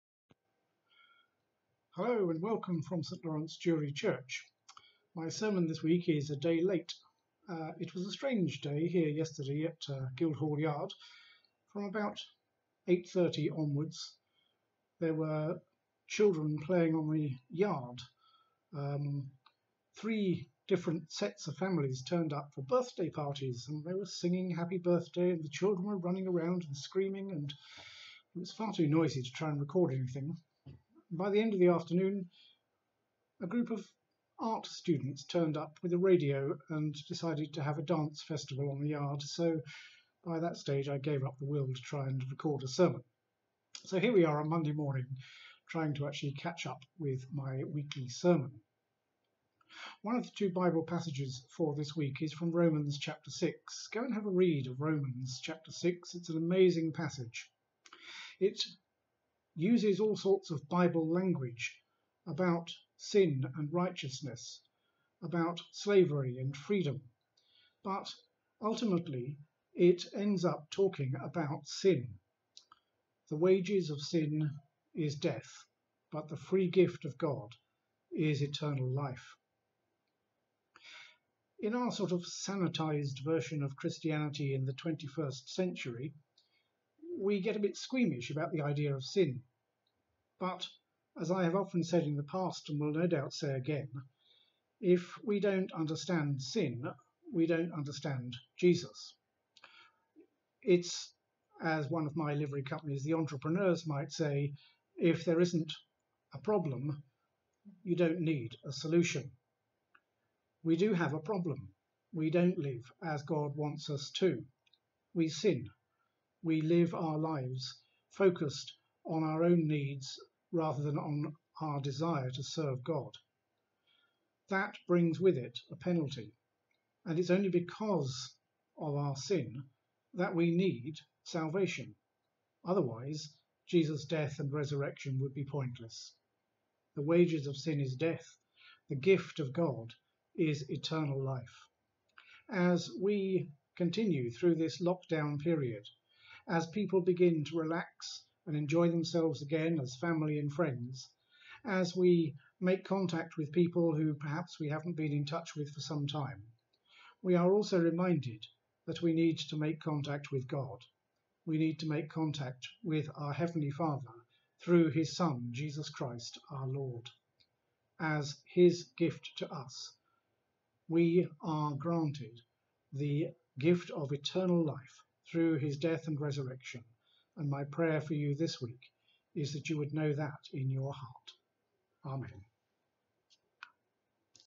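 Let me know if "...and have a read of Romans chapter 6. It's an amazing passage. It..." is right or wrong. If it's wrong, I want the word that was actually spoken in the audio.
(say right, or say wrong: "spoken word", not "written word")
right.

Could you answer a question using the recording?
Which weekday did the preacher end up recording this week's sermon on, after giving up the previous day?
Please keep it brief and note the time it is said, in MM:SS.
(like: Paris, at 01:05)
Monday, at 00:44.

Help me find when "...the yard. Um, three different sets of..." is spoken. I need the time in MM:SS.
00:17.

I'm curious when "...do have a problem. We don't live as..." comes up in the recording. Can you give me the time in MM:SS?
01:50.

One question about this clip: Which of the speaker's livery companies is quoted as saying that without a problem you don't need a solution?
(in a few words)
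the entrepreneurs.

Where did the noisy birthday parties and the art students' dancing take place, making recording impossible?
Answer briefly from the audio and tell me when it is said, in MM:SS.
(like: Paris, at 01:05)
Guildhall Yard, at 00:10.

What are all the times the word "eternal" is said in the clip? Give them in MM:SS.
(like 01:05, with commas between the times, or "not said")
01:18, 02:20, 02:54.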